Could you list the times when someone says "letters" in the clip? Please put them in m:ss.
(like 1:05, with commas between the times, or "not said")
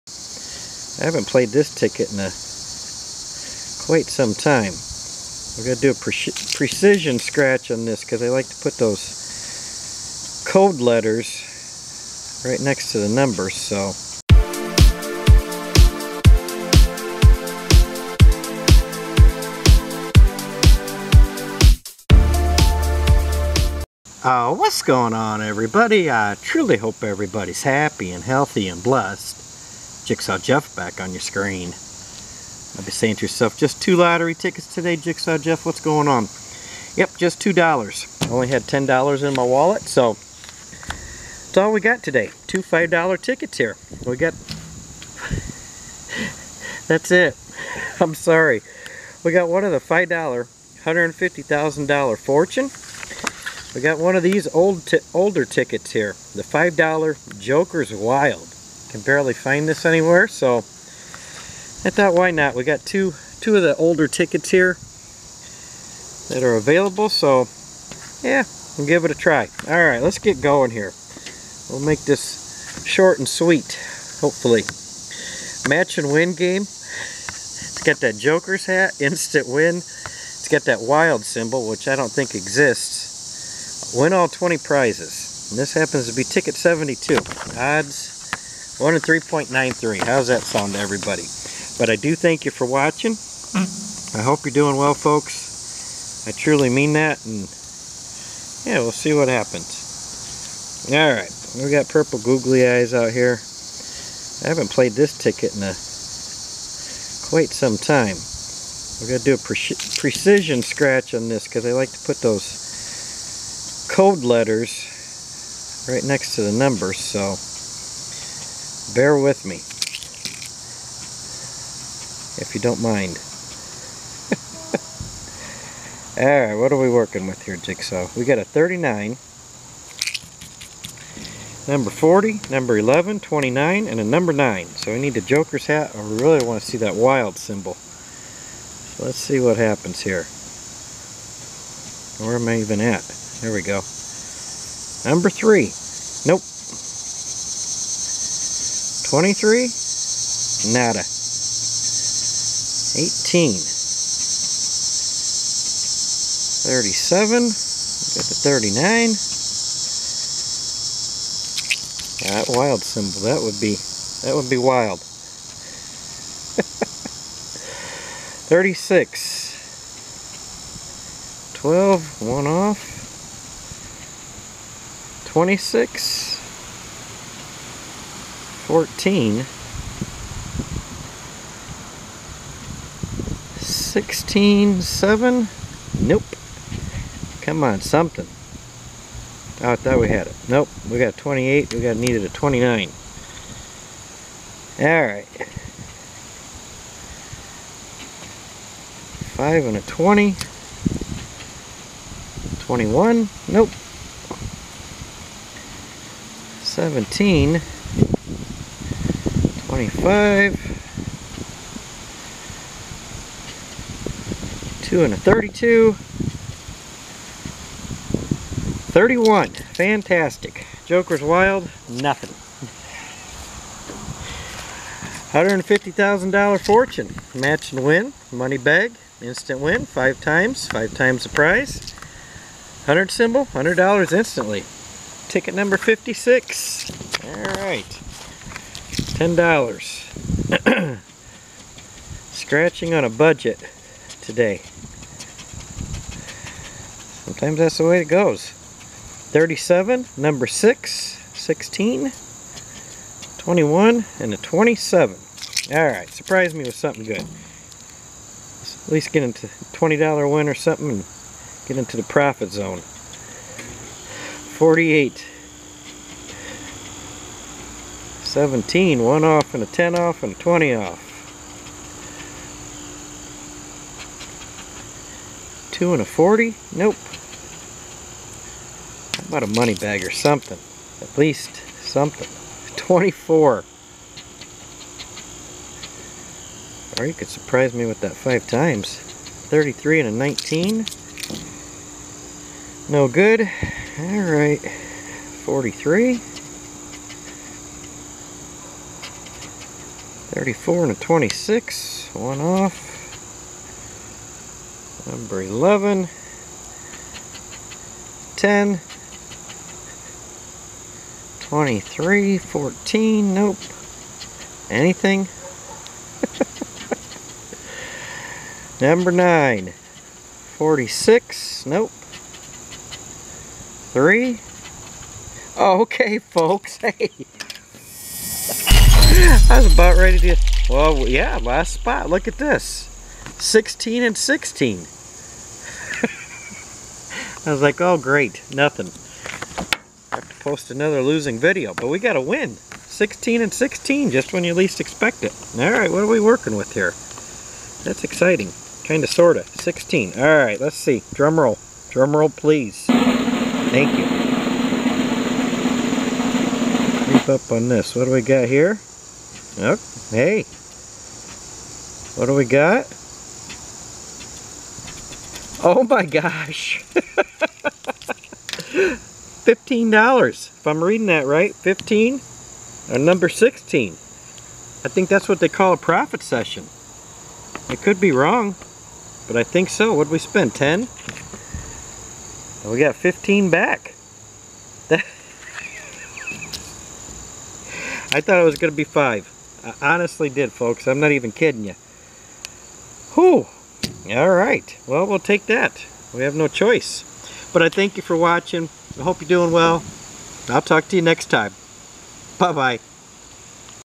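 0:10, 1:54.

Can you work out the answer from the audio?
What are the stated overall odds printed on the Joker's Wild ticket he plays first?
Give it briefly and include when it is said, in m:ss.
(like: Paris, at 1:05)
1 in 3.93, at 1:28.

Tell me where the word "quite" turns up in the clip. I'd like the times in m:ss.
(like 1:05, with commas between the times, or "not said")
0:03, 1:47.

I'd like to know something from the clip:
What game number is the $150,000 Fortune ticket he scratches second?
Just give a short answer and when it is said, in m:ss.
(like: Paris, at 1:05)
56, at 3:55.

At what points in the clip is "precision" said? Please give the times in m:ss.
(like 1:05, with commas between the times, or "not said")
0:06, 1:50.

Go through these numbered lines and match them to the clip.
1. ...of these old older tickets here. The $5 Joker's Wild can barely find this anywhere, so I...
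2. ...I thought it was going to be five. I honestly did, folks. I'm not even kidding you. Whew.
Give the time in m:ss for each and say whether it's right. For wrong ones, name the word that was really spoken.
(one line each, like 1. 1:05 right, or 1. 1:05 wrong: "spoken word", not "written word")
1. 0:54 right
2. 6:28 right.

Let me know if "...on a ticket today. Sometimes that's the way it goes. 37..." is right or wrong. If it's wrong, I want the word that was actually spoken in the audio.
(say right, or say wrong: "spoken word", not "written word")
wrong: "budget", not "ticket".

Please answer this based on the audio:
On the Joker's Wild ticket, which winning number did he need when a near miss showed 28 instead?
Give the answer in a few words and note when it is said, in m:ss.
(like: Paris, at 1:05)
29, at 3:11.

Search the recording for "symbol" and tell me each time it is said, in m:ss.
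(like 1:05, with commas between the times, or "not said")
1:21, 2:17, 2:42, 3:53.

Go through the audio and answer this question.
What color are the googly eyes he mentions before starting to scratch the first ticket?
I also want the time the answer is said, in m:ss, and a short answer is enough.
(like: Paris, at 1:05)
Purple, at 1:41.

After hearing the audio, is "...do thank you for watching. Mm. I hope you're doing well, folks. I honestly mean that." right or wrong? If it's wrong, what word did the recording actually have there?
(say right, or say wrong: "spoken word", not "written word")
wrong: "truly", not "honestly".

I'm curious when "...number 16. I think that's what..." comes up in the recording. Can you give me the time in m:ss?
6:12.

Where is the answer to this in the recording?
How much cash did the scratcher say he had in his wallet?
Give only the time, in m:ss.
0:38.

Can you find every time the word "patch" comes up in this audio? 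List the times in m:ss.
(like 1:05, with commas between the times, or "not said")
not said.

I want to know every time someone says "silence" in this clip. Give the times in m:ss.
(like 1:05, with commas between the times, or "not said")
not said.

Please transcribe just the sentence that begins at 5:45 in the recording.
All right, what are we working with here?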